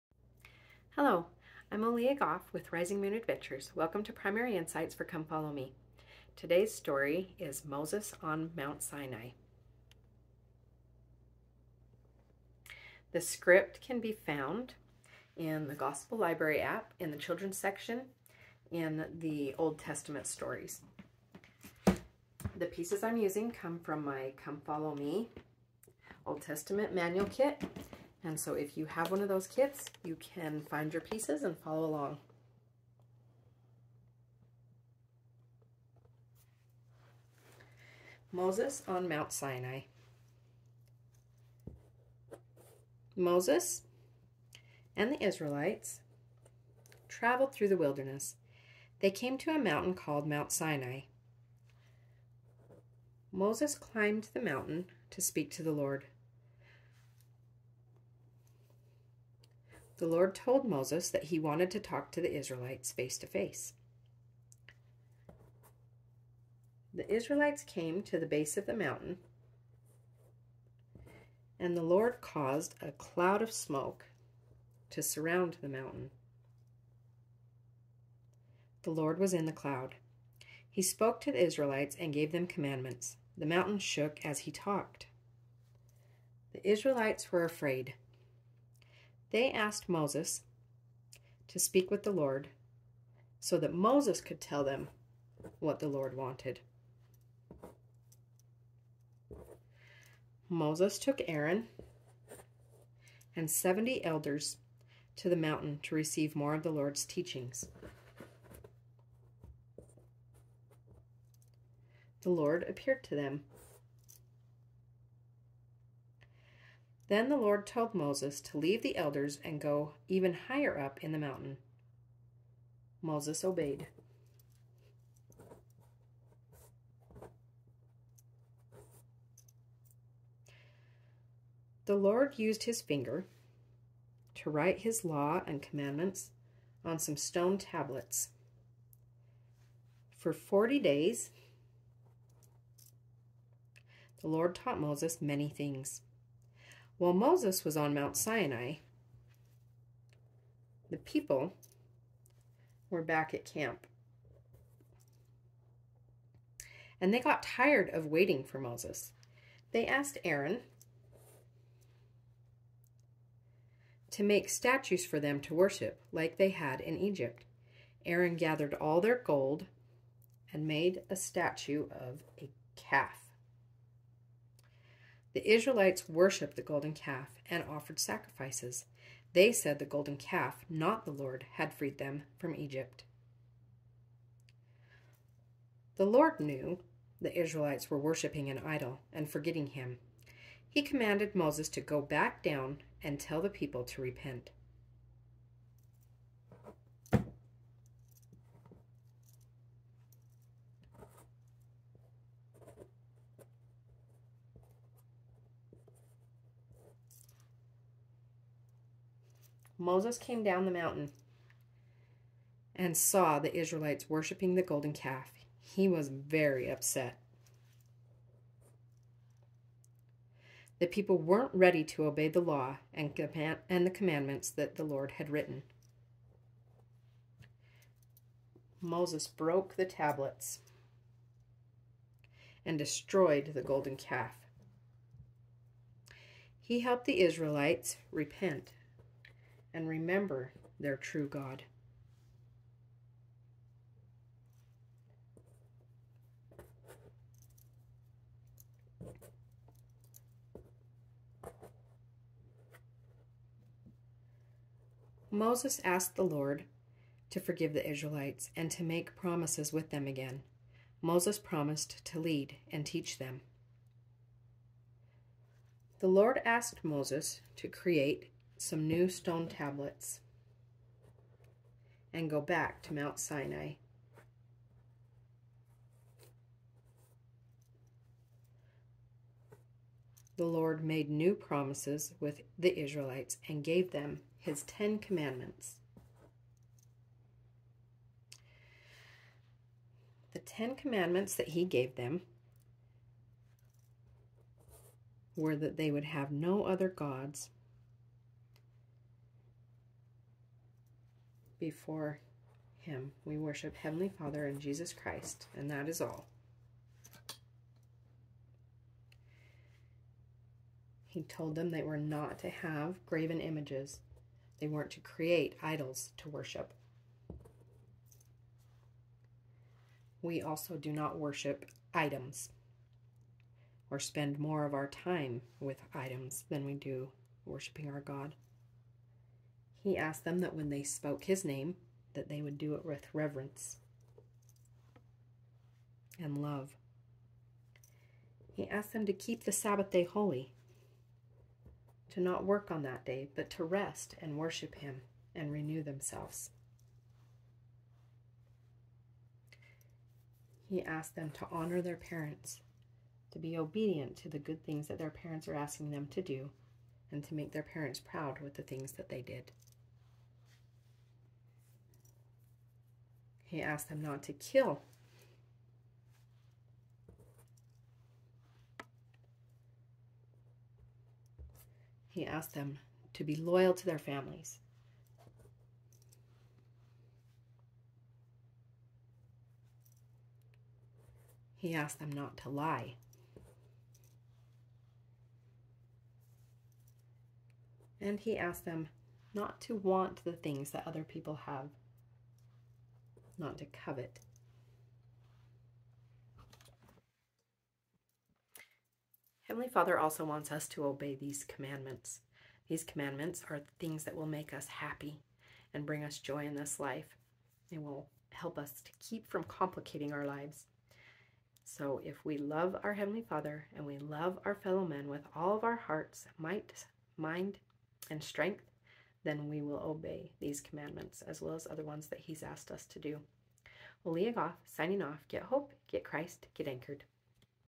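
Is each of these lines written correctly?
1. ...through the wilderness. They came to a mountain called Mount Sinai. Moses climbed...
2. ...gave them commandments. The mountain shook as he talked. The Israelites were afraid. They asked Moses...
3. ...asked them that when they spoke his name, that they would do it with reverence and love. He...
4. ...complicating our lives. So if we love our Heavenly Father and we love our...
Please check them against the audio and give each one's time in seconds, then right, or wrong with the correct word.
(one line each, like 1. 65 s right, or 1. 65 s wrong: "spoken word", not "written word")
1. 47 s right
2. 82 s right
3. 329 s right
4. 409 s right.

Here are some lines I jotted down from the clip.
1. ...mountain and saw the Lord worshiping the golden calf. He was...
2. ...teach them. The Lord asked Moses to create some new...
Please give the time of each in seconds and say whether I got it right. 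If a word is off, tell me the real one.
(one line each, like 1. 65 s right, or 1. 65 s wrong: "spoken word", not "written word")
1. 210 s wrong: "Israelites", not "Lord"
2. 262 s right.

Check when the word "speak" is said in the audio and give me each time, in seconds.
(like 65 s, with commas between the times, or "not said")
55 s, 91 s.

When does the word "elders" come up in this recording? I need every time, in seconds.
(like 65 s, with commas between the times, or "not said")
104 s, 118 s.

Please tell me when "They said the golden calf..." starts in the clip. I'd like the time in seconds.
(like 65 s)
179 s.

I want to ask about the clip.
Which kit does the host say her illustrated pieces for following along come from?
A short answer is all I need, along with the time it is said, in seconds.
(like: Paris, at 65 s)
Come Follow Me Old Testament Manual Kit, at 24 s.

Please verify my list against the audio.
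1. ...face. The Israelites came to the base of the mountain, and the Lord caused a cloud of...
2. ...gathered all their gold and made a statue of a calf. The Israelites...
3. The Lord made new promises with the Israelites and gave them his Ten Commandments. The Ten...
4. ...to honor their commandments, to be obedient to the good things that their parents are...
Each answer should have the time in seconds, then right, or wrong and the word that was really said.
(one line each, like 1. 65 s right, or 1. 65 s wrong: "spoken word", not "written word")
1. 63 s right
2. 168 s right
3. 280 s right
4. 351 s wrong: "parents", not "commandments".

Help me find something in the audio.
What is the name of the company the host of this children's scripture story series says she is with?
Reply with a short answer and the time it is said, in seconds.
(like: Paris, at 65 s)
Rising Moon Adventures, at 2 s.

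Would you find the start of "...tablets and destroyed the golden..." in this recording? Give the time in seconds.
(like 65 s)
229 s.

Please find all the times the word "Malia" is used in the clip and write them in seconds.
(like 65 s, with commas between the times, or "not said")
1 s, 424 s.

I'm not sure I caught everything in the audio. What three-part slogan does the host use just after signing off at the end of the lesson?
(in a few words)
Get hope, get Christ, get anchored.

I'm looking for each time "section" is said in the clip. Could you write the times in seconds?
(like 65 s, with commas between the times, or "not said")
17 s.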